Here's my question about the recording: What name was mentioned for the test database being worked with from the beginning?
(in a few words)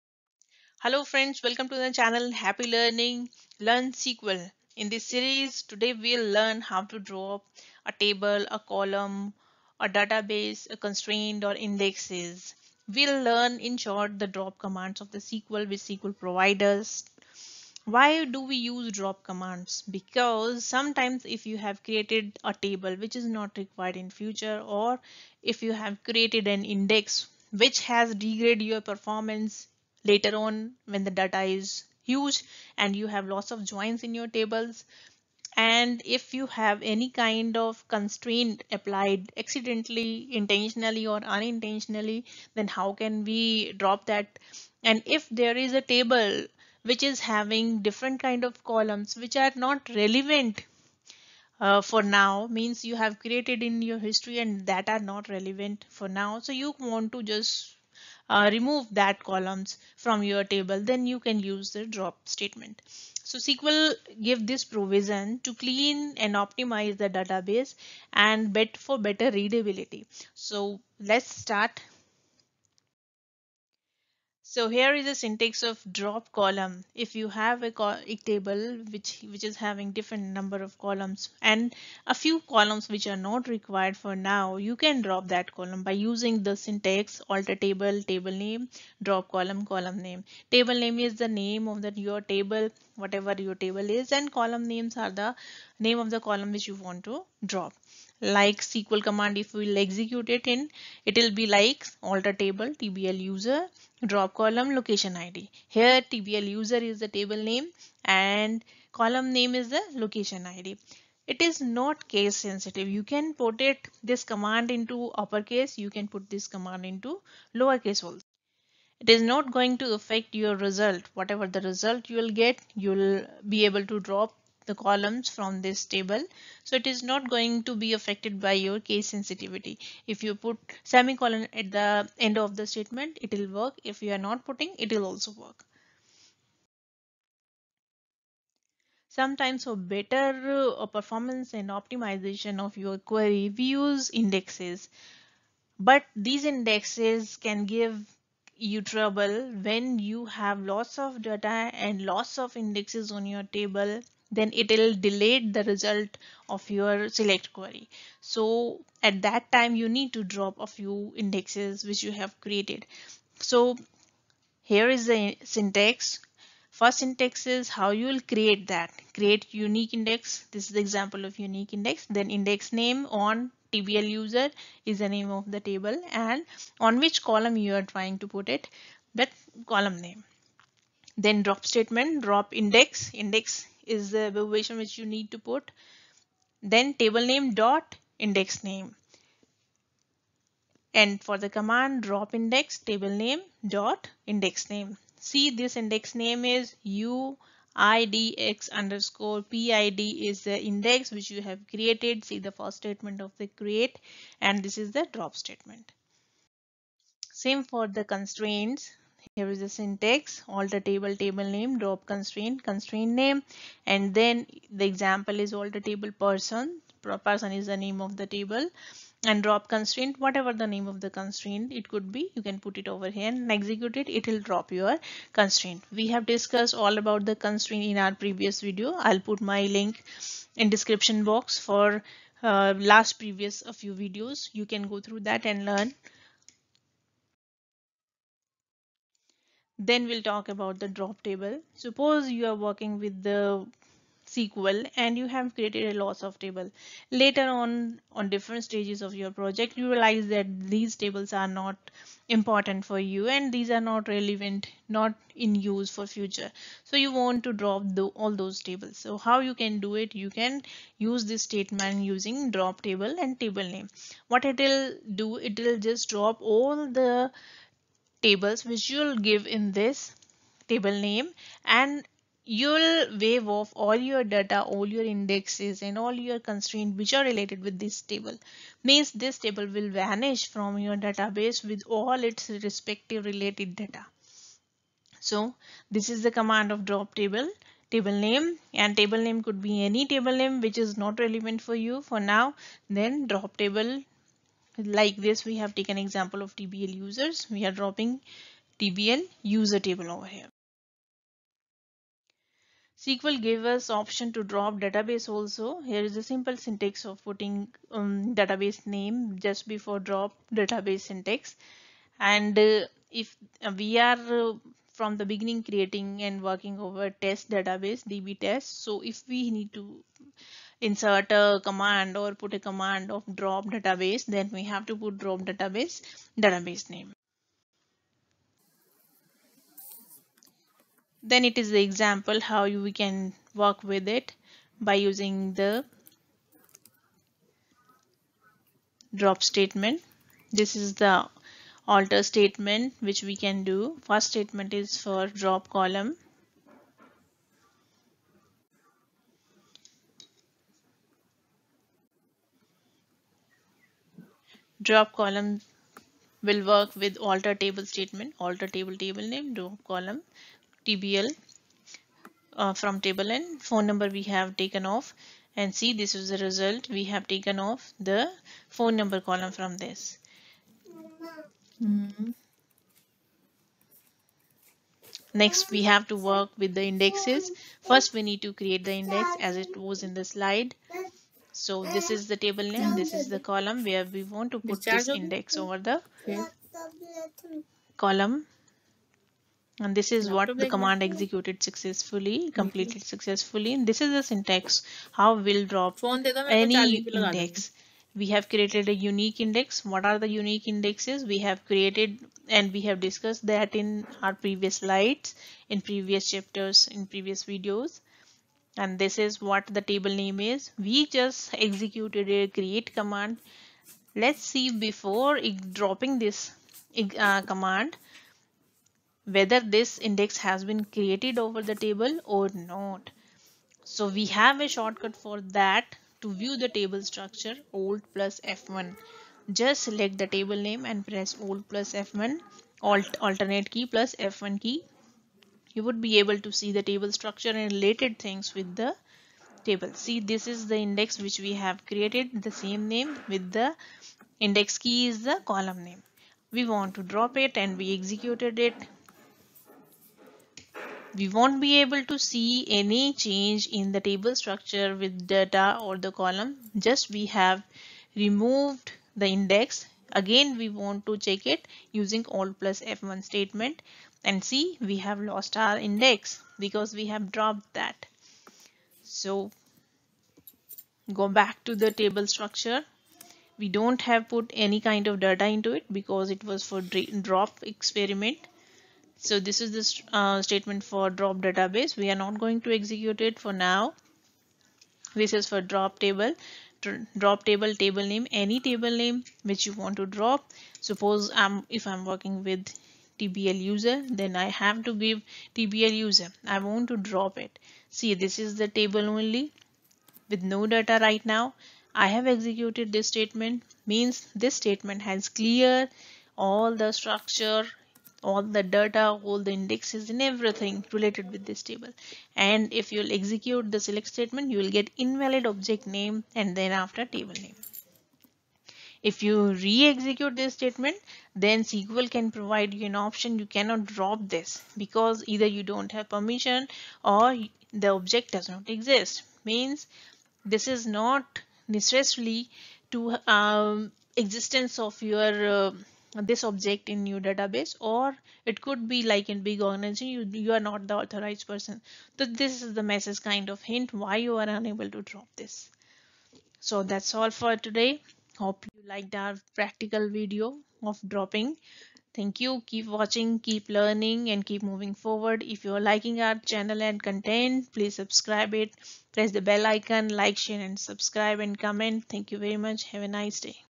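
db test.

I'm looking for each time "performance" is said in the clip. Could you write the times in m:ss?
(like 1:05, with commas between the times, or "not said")
0:28, 2:20.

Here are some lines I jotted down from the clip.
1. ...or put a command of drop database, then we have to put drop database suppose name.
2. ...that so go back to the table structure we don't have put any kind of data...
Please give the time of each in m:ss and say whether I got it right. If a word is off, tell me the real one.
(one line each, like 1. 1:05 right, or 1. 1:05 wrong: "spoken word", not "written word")
1. 5:22 wrong: "database", not "suppose"
2. 7:47 right.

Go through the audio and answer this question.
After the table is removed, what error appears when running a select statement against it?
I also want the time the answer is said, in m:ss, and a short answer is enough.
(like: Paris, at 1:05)
invalid object name, at 8:35.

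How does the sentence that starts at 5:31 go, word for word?
Then it is the example how you, we can work with it by using the drop statement.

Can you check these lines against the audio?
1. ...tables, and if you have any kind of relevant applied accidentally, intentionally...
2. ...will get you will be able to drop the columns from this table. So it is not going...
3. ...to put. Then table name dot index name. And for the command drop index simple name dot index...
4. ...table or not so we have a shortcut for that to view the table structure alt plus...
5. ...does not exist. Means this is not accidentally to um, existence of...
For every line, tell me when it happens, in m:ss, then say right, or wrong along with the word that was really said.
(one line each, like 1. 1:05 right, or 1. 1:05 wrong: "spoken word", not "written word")
1. 0:34 wrong: "constraint", not "relevant"
2. 2:02 right
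3. 3:05 wrong: "table", not "simple"
4. 7:01 right
5. 8:48 wrong: "necessarily", not "accidentally".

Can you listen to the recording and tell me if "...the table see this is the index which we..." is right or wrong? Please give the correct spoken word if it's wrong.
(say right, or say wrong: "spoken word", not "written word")
right.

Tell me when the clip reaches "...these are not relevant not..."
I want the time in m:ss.
4:13.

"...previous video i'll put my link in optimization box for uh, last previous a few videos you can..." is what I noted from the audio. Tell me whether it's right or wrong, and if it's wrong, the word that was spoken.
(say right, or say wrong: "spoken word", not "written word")
wrong: "description", not "optimization".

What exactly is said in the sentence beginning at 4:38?
Means this table will vanish from your database with all its respective related data.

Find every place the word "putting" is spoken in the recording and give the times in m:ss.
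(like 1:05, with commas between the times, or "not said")
2:14, 5:07.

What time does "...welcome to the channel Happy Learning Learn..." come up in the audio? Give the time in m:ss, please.
0:01.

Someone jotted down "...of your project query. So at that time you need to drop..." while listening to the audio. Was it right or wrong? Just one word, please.
wrong.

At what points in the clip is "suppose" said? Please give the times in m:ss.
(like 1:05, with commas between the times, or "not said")
4:01, 8:10.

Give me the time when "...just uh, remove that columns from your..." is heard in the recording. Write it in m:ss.
0:57.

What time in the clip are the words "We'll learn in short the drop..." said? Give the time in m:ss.
0:12.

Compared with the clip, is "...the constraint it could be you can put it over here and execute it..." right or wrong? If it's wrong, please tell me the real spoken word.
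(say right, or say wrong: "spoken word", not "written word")
right.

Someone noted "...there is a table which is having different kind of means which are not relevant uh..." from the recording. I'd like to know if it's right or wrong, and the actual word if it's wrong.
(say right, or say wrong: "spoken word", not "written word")
wrong: "columns", not "means".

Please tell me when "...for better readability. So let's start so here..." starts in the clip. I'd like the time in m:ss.
1:08.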